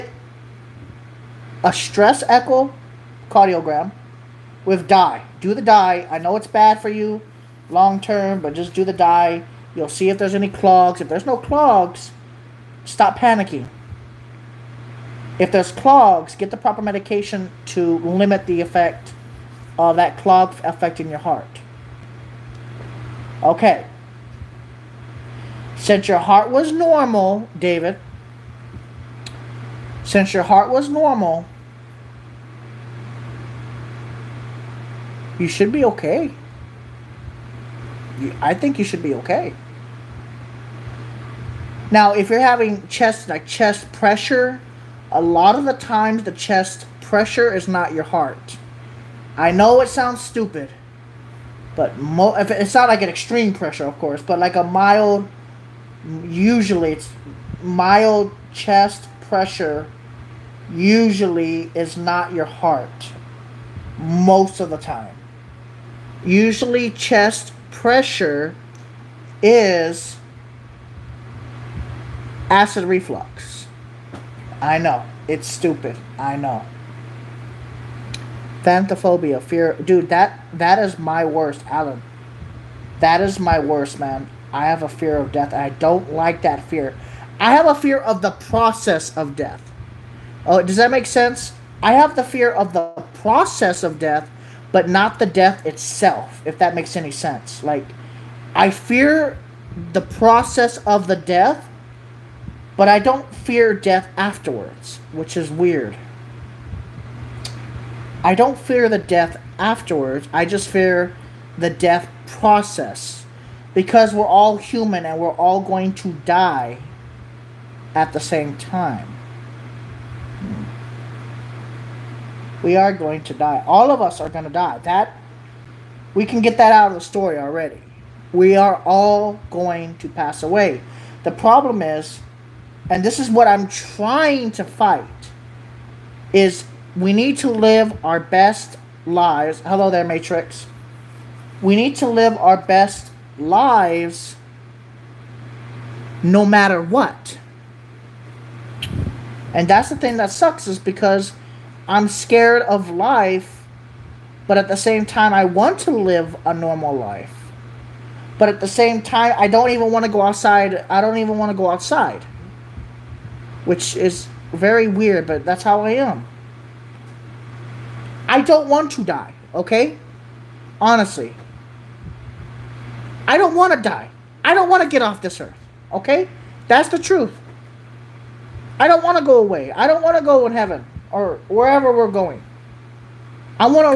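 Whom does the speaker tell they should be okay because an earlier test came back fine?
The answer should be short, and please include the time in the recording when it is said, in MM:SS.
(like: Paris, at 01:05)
David, at 00:27.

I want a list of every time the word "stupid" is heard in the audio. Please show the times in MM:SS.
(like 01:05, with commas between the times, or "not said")
00:50, 01:15.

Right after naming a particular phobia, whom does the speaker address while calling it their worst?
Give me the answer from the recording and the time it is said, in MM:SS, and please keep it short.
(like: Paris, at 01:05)
Alan, at 01:21.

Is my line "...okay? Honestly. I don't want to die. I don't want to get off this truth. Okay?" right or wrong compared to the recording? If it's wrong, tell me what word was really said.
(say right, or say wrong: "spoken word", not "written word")
wrong: "earth", not "truth".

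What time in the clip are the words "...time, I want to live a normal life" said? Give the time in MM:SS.
02:35.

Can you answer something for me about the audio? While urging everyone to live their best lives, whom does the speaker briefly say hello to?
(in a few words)
Matrix.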